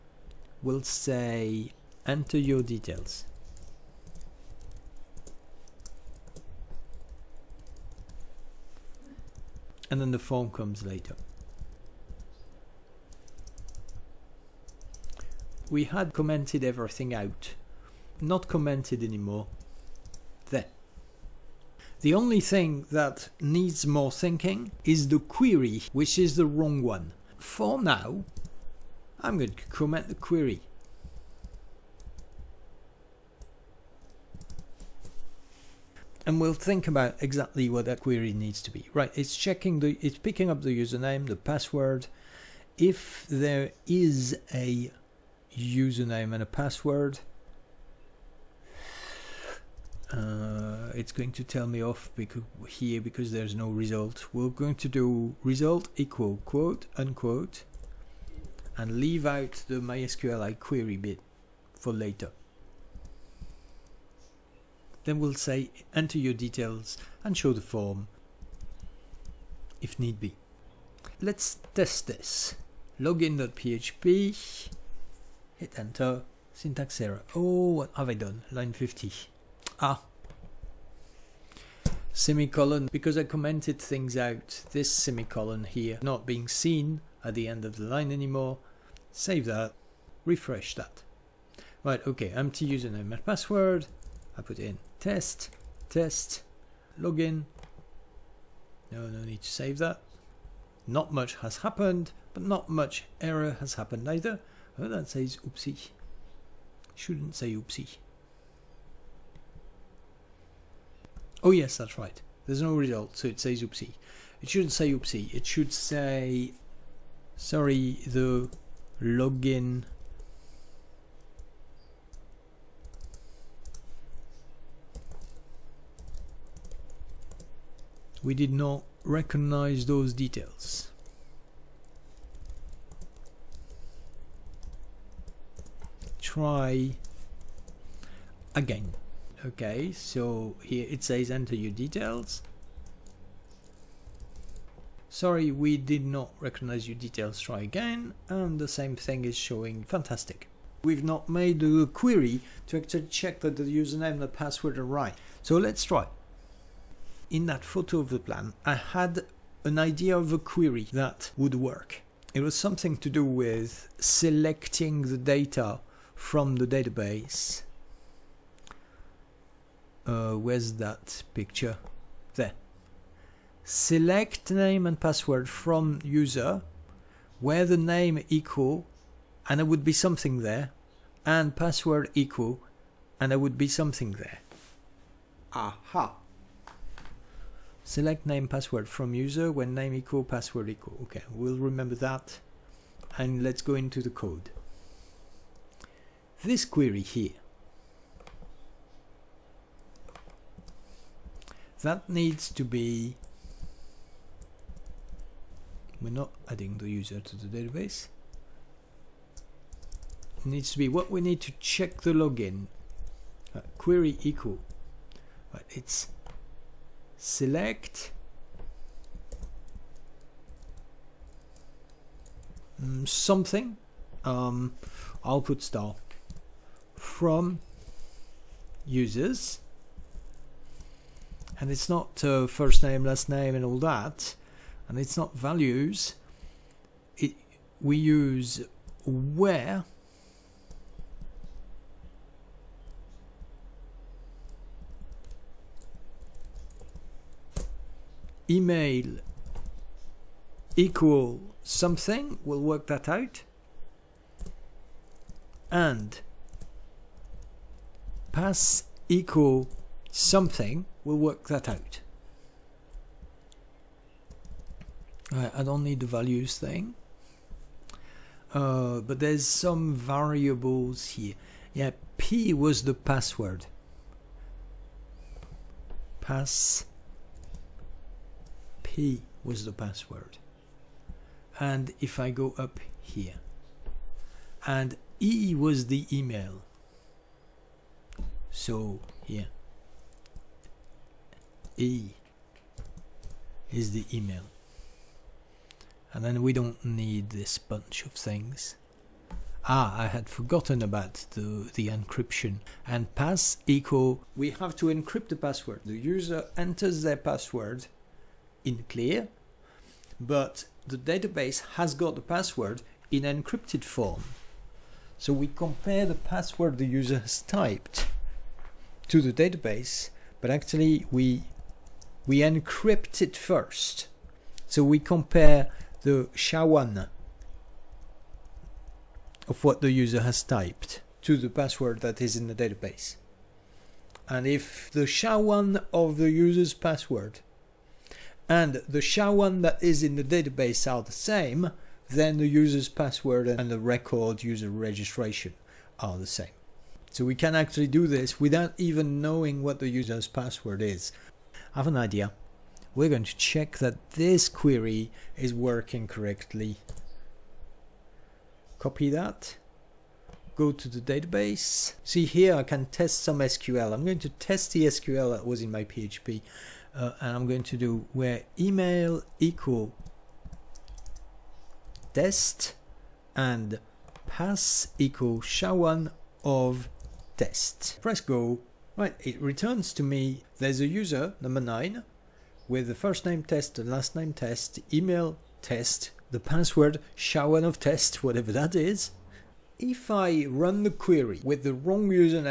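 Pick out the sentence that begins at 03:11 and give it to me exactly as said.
Okay, we'll remember that and let's go into the code this query here.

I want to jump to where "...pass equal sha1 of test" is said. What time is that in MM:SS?
06:14.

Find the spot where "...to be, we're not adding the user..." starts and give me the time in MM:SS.
03:22.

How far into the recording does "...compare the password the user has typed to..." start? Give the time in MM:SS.
05:15.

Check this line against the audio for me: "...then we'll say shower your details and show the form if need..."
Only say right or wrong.
wrong.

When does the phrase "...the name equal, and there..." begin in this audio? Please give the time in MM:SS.
02:57.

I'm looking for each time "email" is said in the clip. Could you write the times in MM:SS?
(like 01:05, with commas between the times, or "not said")
04:08, 04:46, 04:54, 06:08, 06:24.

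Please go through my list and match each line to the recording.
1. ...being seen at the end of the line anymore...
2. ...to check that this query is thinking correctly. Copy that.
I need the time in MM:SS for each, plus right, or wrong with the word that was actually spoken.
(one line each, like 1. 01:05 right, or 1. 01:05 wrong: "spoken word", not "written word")
1. 01:26 right
2. 05:53 wrong: "working", not "thinking".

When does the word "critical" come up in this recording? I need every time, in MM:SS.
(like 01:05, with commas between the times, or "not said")
not said.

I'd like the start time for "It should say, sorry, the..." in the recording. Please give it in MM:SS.
01:55.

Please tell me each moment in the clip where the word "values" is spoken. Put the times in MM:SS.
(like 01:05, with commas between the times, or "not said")
03:55, 04:26.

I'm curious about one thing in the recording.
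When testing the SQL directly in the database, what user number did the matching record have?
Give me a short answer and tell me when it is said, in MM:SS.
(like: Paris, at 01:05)
9, at 06:21.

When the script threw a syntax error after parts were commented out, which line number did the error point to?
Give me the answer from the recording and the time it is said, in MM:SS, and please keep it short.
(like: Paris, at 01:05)
50, at 01:18.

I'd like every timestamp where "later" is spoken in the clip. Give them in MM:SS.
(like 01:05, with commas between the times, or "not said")
00:10, 01:01.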